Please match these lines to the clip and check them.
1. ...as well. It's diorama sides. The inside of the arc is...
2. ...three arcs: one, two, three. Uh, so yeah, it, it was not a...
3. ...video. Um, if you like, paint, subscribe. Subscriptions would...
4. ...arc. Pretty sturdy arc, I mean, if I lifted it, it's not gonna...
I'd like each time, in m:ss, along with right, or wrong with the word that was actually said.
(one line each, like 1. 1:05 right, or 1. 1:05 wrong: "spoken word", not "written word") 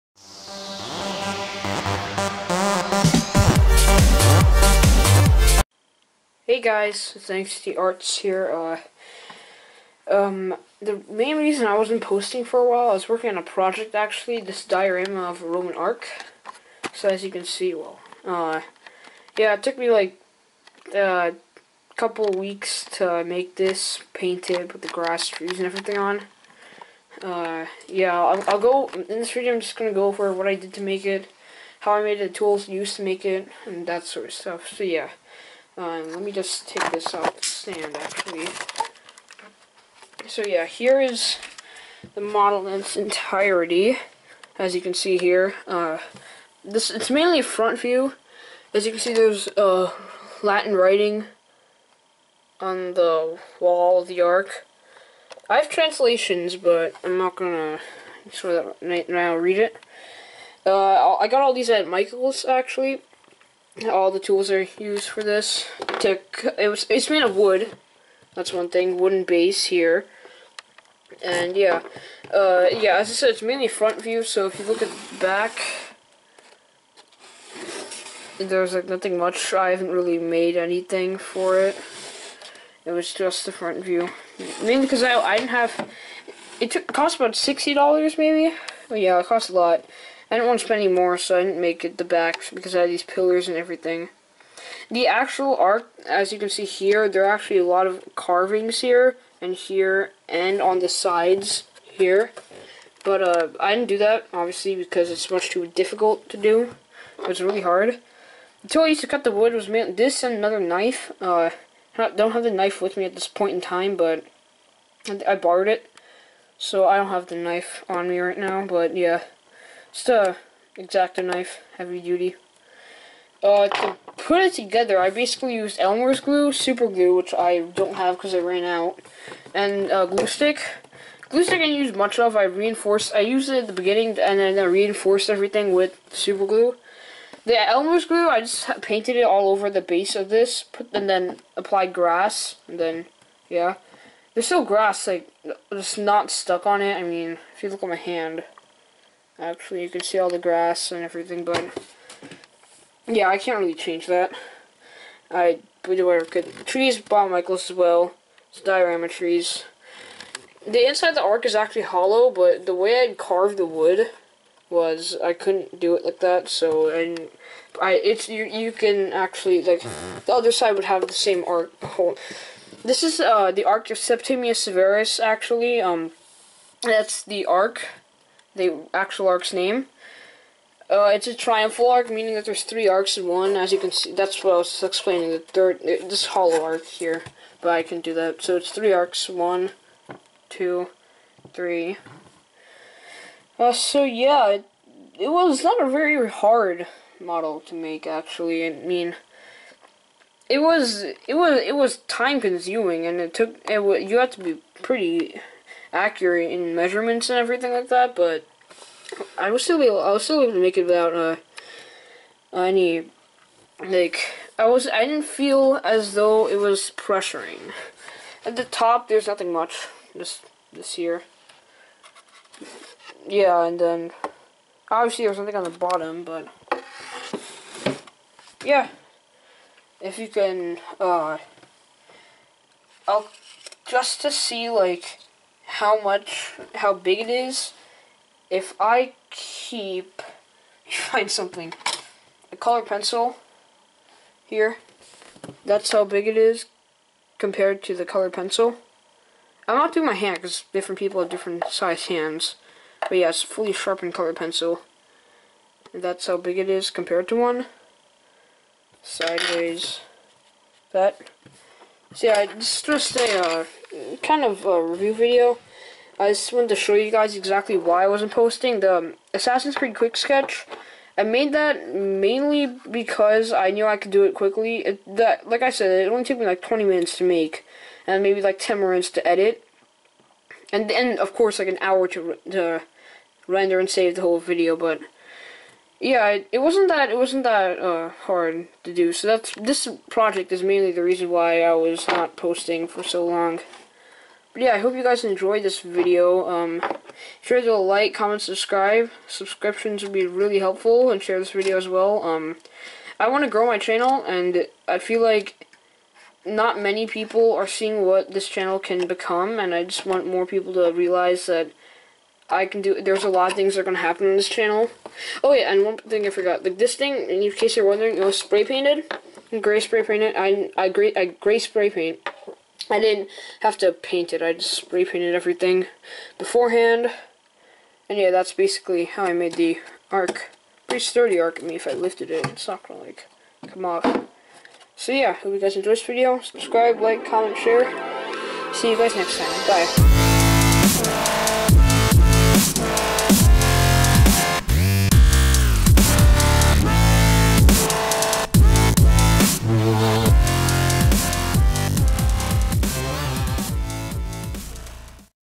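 1. 2:37 wrong: "trees", not "sides"
2. 3:08 right
3. 4:55 wrong: "comment", not "paint"
4. 5:30 right.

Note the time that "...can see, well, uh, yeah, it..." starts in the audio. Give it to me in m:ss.
0:17.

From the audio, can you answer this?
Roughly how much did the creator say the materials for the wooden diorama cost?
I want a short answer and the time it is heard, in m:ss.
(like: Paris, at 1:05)
$60, at 1:27.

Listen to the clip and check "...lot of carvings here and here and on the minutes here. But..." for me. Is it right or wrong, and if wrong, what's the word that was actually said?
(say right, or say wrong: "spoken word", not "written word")
wrong: "sides", not "minutes".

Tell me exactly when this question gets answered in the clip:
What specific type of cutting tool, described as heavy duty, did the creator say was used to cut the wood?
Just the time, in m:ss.
2:00.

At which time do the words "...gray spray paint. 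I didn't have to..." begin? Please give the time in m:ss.
5:21.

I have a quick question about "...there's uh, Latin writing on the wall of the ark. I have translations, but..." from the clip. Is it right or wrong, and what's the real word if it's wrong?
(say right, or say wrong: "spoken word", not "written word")
right.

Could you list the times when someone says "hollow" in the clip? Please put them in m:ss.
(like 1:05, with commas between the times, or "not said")
2:41, 3:06.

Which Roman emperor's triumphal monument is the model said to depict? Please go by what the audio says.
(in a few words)
Septimius Severus.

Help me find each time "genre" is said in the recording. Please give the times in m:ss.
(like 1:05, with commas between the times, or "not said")
not said.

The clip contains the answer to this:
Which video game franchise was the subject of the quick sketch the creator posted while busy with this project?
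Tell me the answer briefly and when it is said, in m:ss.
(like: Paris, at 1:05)
Assassin's Creed, at 4:29.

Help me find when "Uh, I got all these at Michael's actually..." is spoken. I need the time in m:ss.
1:00.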